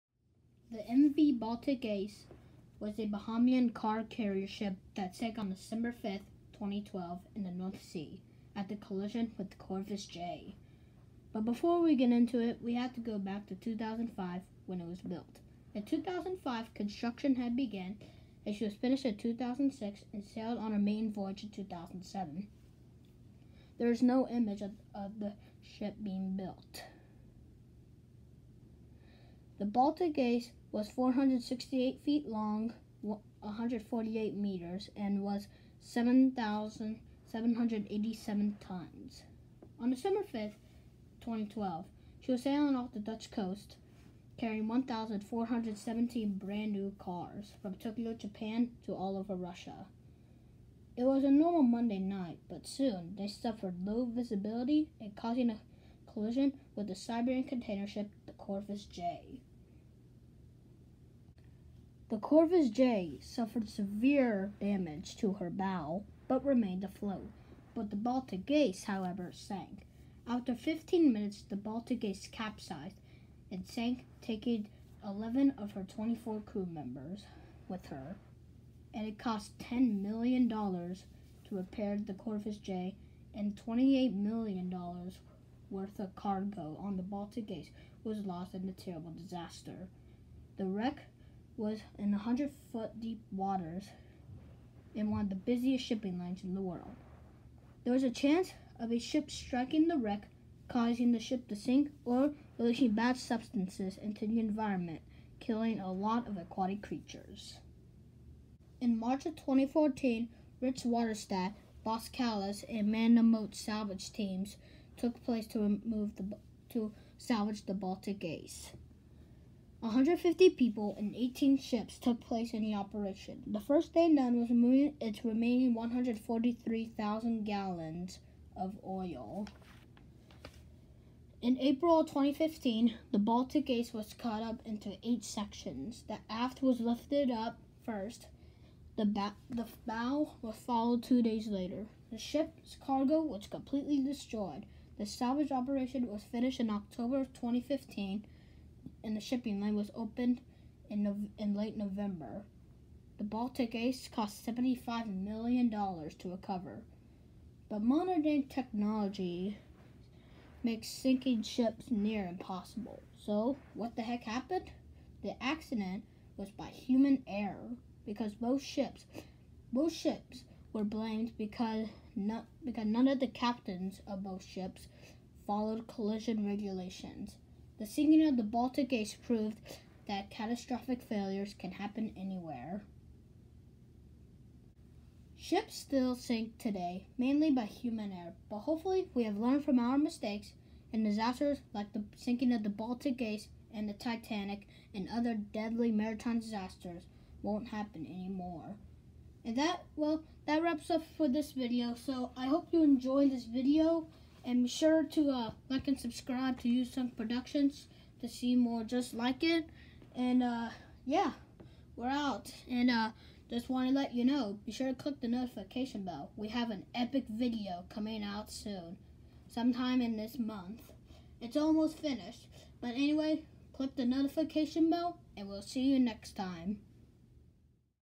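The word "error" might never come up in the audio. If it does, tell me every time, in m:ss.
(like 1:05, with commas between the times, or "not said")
2:47, 3:08.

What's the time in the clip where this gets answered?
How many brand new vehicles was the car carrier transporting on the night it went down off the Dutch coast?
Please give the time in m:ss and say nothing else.
0:44.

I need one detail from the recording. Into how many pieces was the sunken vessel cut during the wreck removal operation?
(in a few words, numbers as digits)
8.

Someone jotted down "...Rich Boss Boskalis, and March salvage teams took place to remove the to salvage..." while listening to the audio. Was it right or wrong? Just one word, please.
wrong.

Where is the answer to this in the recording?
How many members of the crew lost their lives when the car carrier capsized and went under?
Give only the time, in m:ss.
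1:15.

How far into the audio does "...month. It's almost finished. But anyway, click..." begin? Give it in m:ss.
3:40.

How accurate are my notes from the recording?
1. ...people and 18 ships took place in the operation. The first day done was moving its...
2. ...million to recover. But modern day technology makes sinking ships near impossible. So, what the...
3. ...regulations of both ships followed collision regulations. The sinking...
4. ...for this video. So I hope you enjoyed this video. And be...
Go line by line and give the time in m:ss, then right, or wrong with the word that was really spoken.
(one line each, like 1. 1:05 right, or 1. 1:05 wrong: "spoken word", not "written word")
1. 2:00 right
2. 2:35 right
3. 2:53 wrong: "captains", not "regulations"
4. 3:21 right.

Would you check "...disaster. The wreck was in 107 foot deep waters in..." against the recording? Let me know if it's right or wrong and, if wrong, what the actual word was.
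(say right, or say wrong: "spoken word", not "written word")
wrong: "100", not "107".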